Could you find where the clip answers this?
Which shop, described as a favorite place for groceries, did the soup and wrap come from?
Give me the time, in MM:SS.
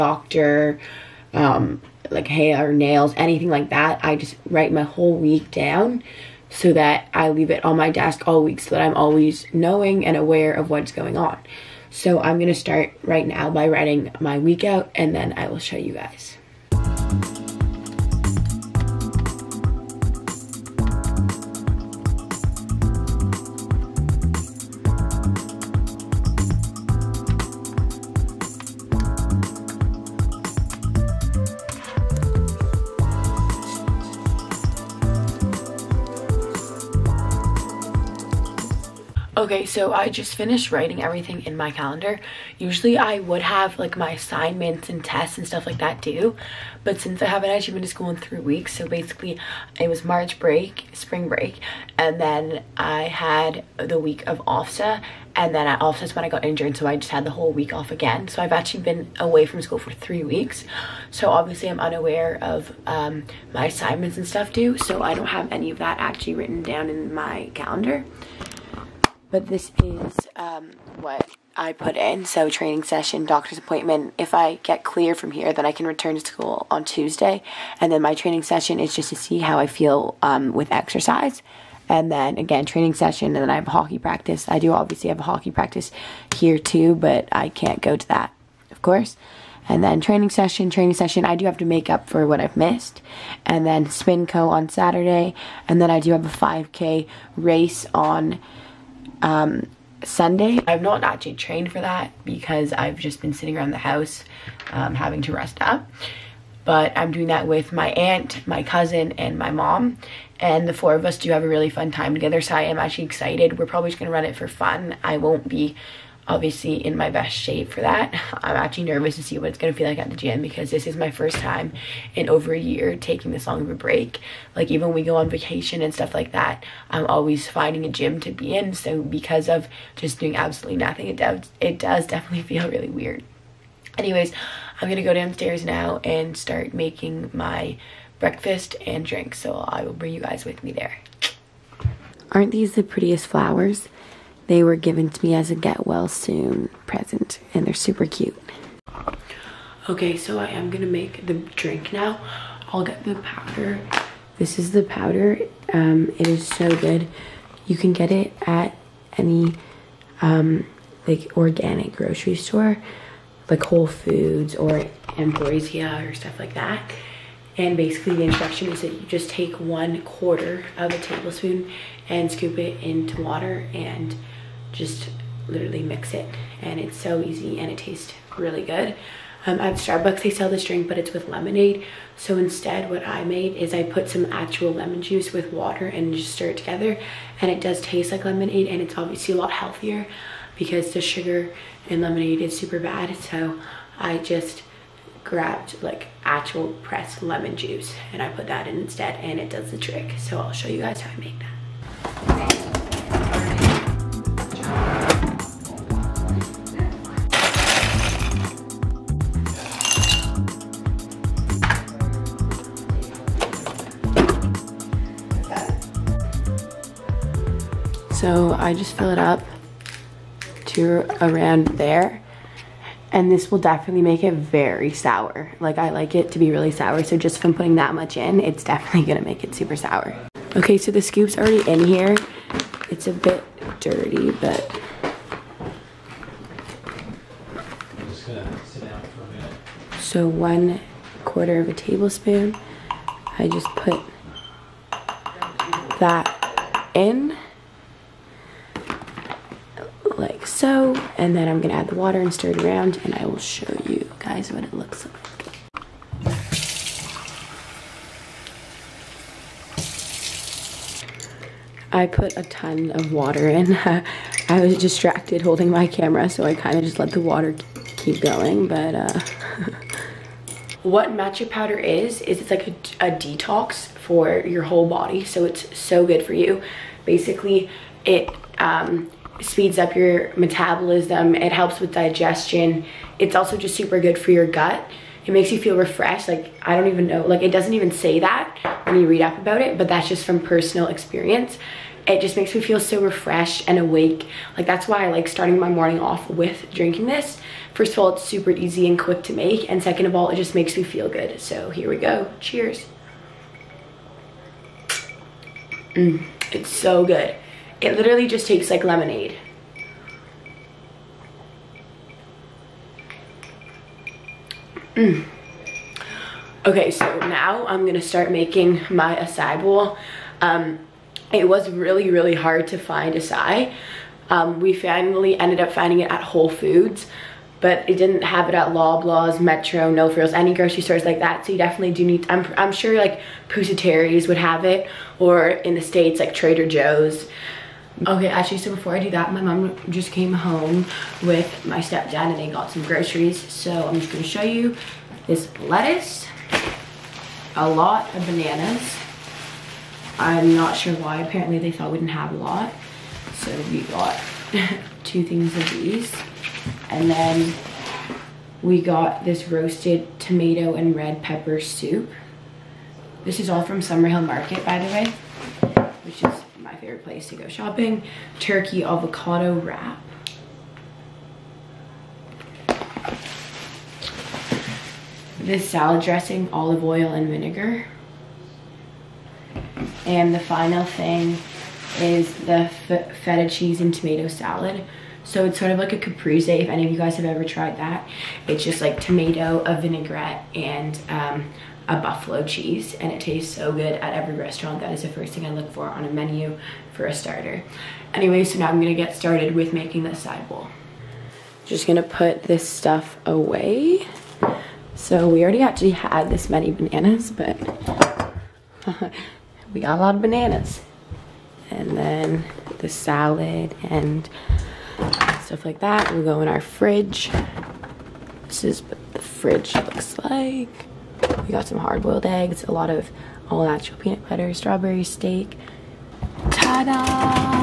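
06:03.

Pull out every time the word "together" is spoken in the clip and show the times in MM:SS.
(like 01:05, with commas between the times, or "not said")
01:52, 03:06.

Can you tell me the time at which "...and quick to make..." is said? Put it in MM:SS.
04:58.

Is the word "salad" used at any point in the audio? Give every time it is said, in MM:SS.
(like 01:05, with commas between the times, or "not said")
06:15, 06:24, 06:52.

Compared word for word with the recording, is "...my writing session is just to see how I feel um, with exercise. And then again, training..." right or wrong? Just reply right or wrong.
wrong.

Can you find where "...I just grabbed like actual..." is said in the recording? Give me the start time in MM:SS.
03:13.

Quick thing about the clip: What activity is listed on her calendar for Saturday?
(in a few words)
Spinco.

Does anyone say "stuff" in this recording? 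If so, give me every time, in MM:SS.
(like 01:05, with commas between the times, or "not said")
00:45, 01:04, 02:05, 02:46, 06:42, 06:55.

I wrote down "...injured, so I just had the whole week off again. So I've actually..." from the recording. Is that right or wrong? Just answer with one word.
right.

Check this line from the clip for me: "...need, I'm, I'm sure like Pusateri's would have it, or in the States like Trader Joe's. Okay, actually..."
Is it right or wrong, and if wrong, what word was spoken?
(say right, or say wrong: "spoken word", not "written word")
right.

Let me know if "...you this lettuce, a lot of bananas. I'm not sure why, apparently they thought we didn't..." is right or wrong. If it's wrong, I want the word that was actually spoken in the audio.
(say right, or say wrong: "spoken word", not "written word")
right.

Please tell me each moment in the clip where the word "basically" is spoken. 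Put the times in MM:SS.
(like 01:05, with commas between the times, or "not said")
00:48, 02:47, 04:37.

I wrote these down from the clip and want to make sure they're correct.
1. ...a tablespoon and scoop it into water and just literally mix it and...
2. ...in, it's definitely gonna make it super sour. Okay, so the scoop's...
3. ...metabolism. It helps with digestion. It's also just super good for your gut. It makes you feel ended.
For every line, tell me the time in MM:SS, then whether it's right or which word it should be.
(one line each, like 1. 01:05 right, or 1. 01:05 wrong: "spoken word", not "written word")
1. 02:50 right
2. 03:48 right
3. 04:40 wrong: "refreshed", not "ended".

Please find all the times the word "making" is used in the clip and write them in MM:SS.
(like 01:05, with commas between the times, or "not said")
02:16, 05:18, 06:39.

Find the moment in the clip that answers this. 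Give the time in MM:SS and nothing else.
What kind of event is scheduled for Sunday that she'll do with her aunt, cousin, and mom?
01:36.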